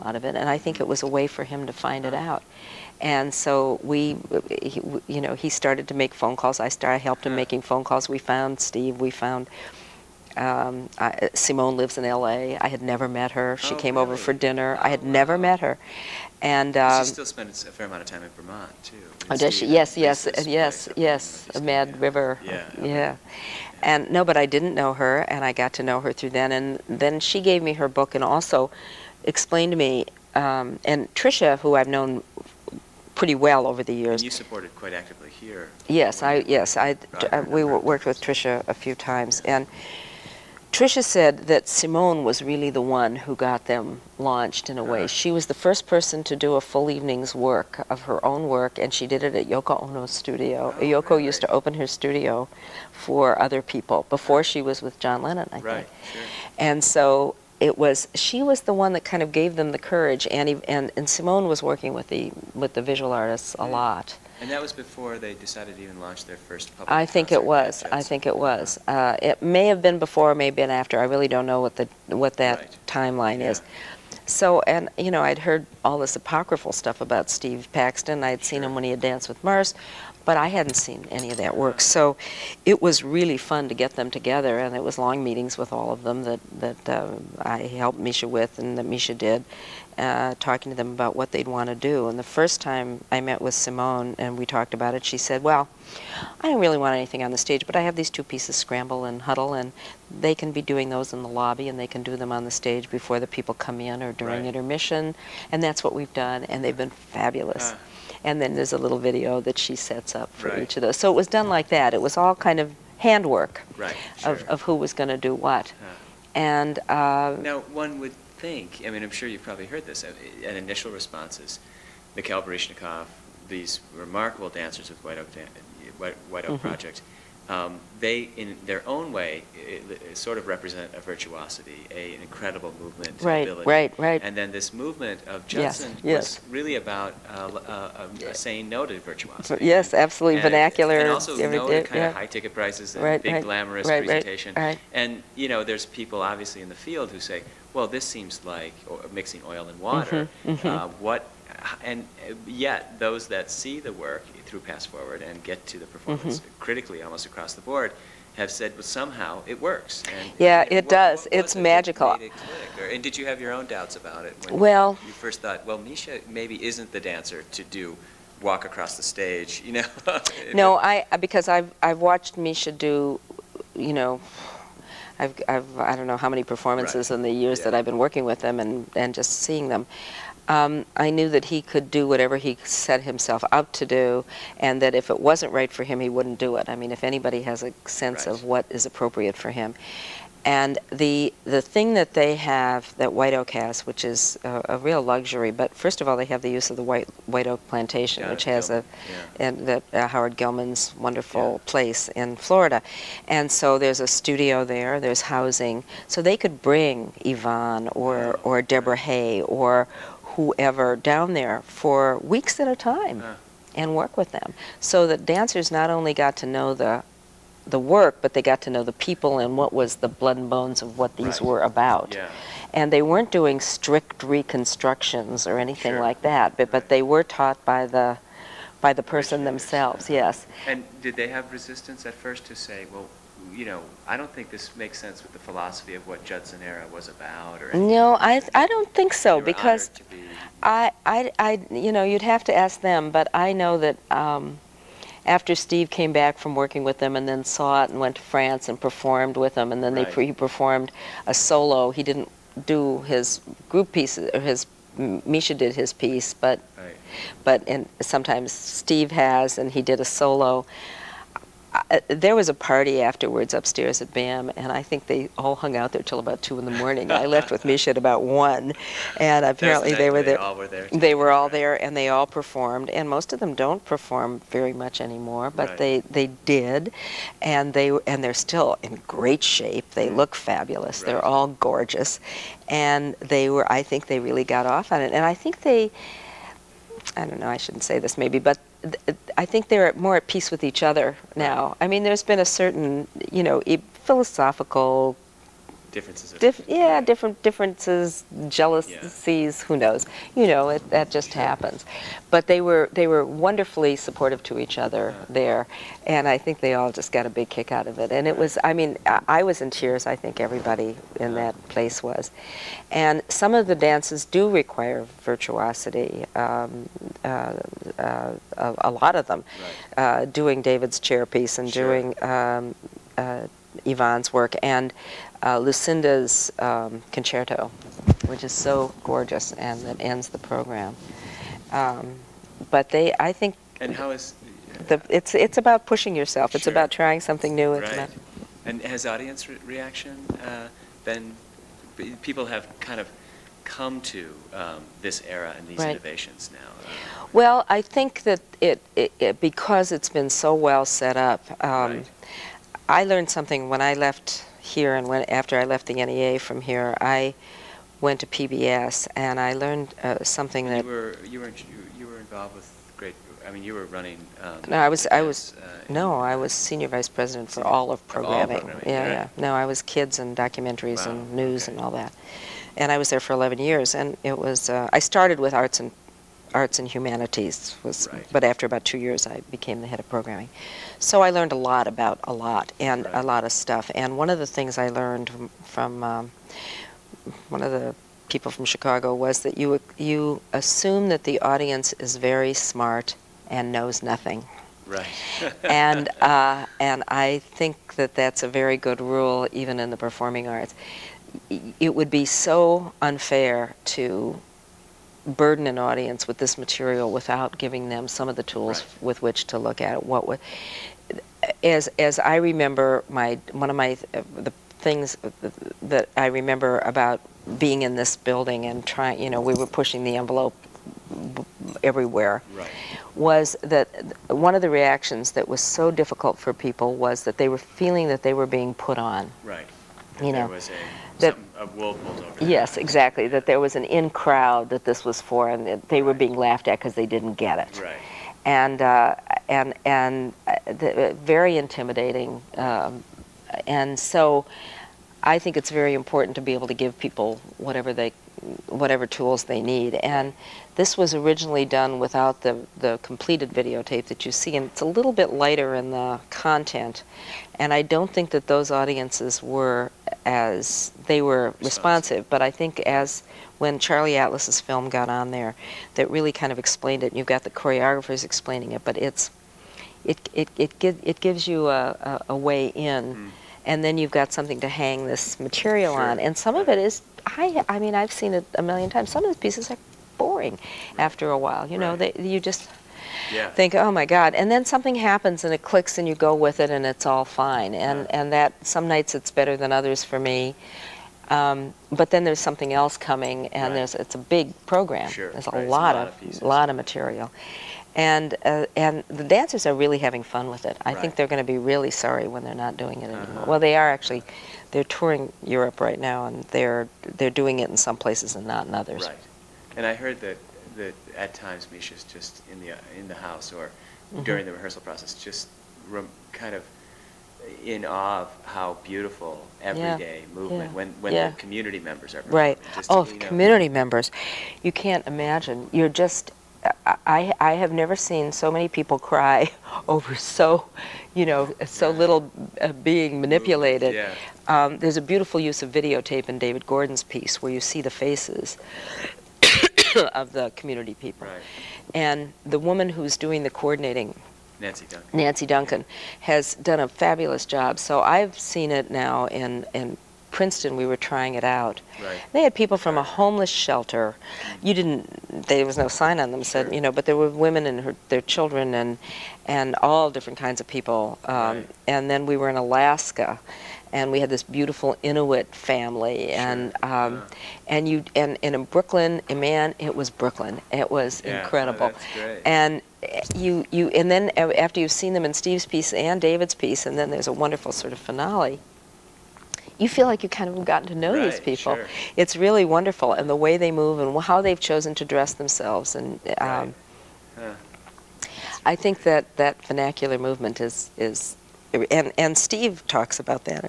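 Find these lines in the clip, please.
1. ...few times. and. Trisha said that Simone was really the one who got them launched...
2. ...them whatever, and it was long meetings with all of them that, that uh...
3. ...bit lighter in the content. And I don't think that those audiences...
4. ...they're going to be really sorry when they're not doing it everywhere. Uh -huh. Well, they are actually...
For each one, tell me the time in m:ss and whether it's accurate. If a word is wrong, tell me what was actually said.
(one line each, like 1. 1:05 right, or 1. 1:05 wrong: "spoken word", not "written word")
1. 0:38 right
2. 1:23 wrong: "together", not "whatever"
3. 7:35 right
4. 8:21 wrong: "anymore", not "everywhere".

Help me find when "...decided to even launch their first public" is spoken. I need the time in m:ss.
1:05.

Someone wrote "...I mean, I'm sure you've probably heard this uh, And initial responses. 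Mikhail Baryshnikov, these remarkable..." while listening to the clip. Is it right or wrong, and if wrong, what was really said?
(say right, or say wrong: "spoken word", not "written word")
right.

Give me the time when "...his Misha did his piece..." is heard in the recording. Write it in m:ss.
4:14.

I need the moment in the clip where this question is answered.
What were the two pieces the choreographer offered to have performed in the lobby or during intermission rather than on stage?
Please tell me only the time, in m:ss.
1:38.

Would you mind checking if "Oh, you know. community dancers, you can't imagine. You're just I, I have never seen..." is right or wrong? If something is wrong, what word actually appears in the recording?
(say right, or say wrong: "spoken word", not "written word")
wrong: "members", not "dancers".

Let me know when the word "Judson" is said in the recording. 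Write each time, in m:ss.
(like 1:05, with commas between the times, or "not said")
2:15, 3:56.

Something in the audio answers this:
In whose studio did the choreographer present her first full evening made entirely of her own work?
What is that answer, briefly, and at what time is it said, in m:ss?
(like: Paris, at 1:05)
Yoko Ono, at 0:49.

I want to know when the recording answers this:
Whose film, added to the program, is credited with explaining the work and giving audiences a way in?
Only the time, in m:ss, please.
7:43.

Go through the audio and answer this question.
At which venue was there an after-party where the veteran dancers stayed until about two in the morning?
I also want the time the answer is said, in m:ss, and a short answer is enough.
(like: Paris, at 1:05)
BAM, at 4:24.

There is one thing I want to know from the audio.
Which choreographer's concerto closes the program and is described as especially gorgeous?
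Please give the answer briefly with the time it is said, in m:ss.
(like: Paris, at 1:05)
Lucinda, at 5:25.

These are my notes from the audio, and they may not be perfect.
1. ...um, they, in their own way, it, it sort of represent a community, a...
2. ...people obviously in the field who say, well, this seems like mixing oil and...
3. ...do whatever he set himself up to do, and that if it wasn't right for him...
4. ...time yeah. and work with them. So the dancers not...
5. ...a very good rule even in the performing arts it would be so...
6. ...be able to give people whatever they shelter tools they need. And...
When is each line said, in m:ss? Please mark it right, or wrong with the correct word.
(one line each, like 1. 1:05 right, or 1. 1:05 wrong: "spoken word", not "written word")
1. 2:07 wrong: "virtuosity", not "community"
2. 2:25 right
3. 3:01 right
4. 3:32 right
5. 6:38 right
6. 7:26 wrong: "whatever", not "shelter".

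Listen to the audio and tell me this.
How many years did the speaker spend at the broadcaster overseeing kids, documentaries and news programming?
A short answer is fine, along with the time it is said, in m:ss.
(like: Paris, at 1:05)
11, at 6:13.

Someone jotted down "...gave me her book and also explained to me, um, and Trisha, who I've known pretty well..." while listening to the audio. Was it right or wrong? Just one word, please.
right.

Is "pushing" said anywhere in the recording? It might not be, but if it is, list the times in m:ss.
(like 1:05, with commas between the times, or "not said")
5:35, 6:59.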